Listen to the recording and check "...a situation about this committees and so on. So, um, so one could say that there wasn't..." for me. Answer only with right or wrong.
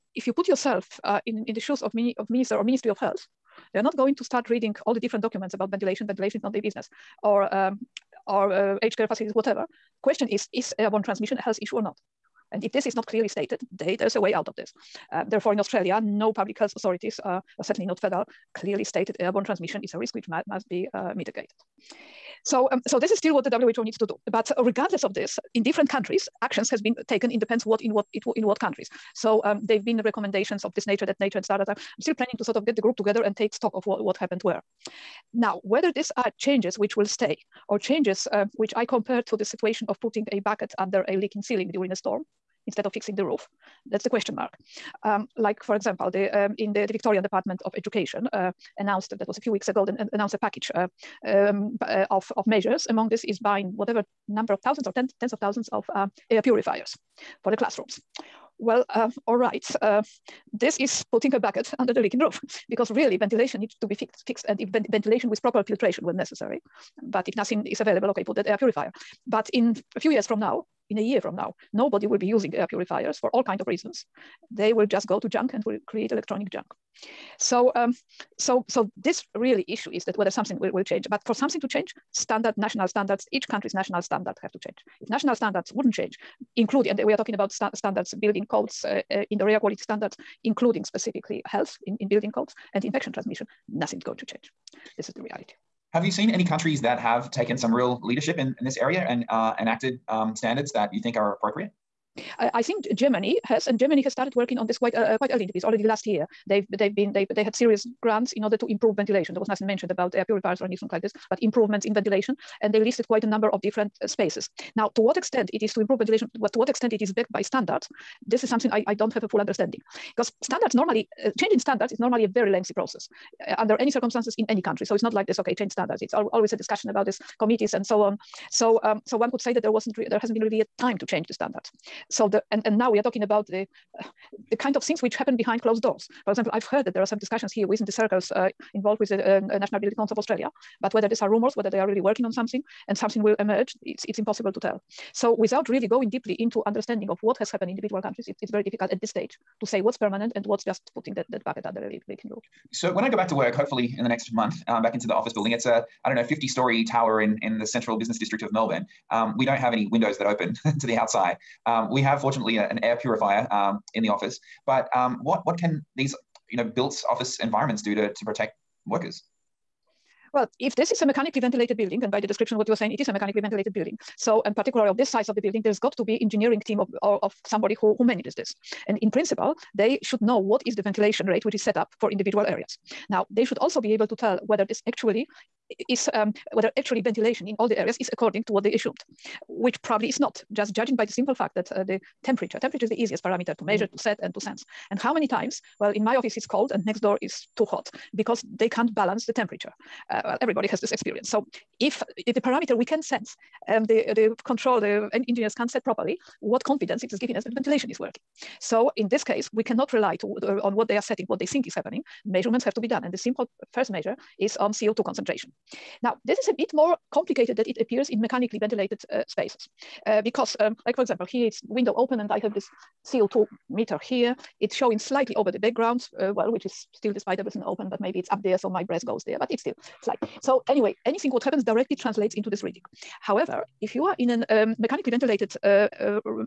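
wrong.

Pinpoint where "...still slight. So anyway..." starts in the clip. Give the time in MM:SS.
03:49.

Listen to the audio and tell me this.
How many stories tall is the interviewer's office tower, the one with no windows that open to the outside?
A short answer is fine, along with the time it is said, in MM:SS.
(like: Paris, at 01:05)
50, at 02:36.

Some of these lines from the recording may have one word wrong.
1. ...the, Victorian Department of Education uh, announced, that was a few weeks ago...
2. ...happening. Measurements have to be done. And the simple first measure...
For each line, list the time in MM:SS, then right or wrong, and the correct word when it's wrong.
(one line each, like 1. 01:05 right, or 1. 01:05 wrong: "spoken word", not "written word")
1. 00:46 right
2. 03:31 right.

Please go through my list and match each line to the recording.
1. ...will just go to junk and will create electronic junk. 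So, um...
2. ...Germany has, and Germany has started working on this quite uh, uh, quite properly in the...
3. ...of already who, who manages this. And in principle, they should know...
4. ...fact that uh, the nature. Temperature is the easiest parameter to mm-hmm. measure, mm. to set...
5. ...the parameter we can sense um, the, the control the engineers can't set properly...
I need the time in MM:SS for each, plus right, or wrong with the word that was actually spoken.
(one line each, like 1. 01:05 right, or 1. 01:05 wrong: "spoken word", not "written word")
1. 01:14 right
2. 01:42 wrong: "early", not "properly"
3. 02:57 wrong: "somebody", not "already"
4. 03:11 wrong: "temperature", not "nature"
5. 03:22 right.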